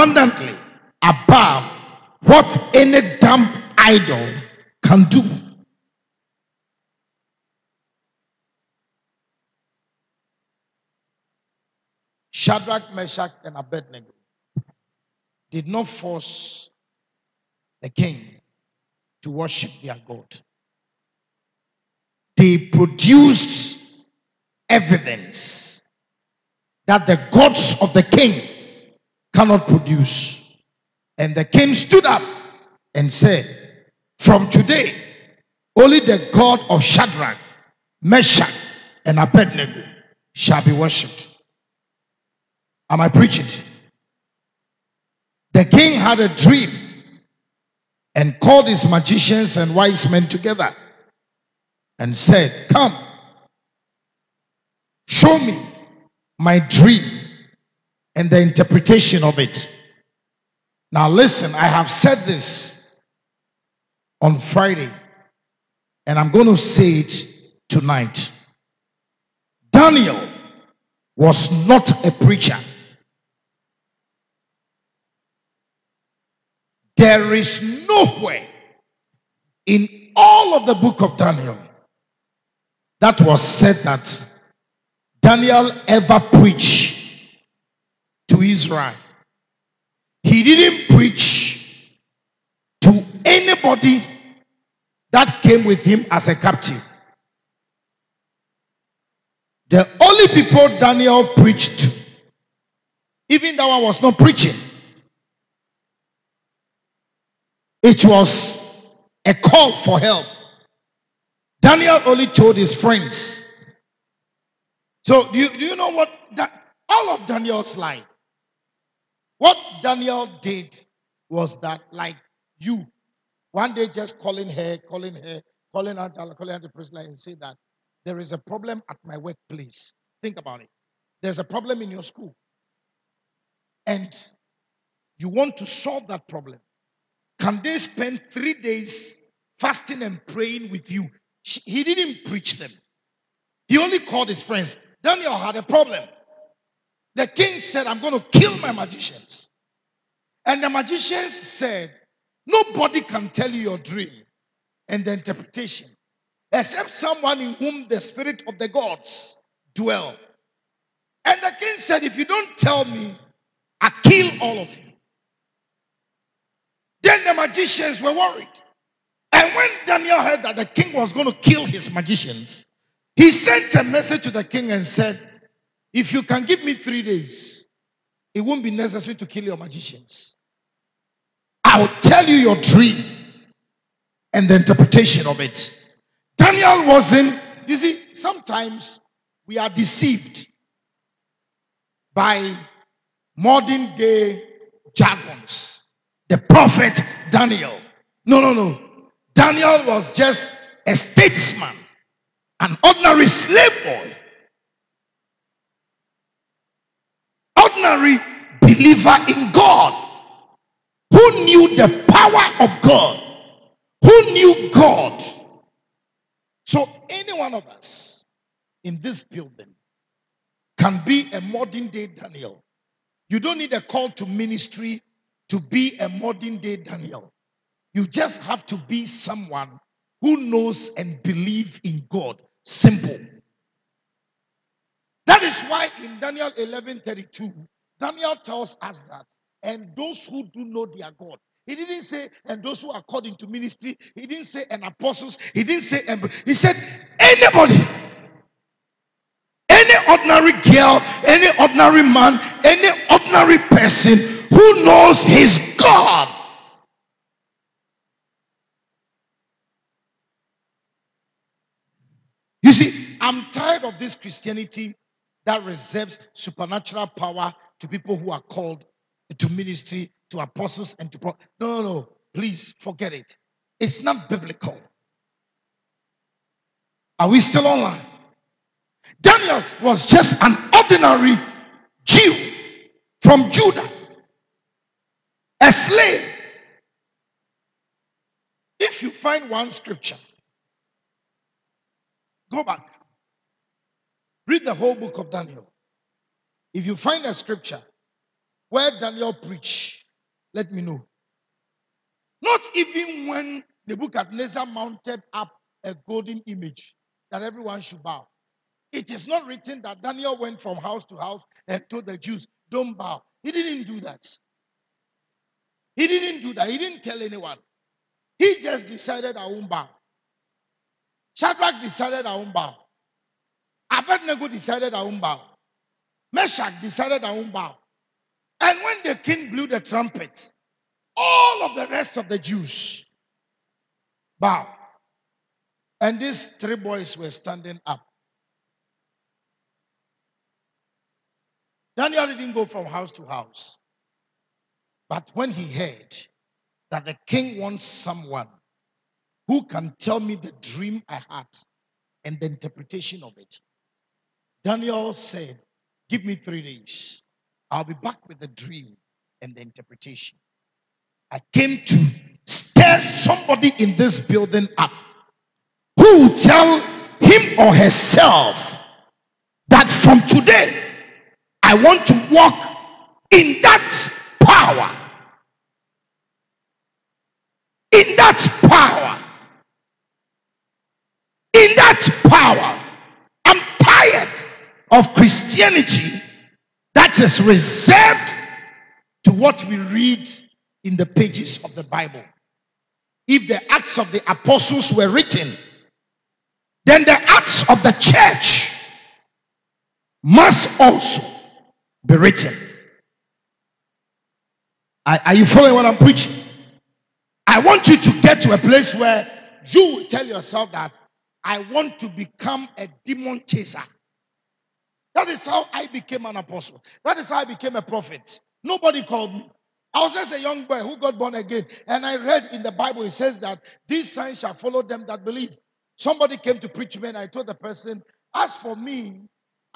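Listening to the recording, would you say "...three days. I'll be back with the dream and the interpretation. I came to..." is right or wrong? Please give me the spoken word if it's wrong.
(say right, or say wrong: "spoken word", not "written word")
right.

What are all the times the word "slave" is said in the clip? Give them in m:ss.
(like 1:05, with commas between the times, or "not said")
3:23, 4:45.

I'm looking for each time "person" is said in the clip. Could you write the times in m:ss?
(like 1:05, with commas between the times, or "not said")
4:13, 7:07.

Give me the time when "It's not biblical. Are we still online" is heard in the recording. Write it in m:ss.
4:33.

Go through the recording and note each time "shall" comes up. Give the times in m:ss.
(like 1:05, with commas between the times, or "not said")
0:40, 7:04.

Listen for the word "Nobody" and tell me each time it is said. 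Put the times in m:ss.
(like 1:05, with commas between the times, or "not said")
2:32, 6:58.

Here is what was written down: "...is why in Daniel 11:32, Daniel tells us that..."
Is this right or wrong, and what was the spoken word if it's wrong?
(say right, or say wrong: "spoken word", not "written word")
right.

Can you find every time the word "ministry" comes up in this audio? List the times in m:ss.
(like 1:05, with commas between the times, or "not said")
3:44, 4:03, 4:29.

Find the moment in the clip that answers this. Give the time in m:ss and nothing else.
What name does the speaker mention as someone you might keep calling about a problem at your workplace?
2:06.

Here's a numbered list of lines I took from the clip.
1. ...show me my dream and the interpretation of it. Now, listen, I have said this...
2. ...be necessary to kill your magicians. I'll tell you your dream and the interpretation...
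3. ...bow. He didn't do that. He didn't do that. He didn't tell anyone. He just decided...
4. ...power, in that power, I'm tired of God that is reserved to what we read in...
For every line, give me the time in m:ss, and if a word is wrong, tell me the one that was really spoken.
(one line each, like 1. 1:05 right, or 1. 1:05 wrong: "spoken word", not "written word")
1. 0:55 right
2. 2:58 right
3. 5:12 right
4. 6:19 wrong: "Christianity", not "God".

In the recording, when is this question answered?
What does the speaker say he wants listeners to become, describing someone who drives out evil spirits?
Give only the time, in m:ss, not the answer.
6:53.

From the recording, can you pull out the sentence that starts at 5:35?
And these three boys were standing up.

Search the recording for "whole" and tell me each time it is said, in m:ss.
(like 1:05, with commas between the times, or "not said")
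4:54.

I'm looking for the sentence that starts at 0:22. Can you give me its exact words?
They produced evidence that the gods of the king cannot produce.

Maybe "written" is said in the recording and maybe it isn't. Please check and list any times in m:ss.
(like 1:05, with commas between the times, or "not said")
5:09, 6:35, 6:42.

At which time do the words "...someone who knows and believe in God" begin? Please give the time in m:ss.
3:49.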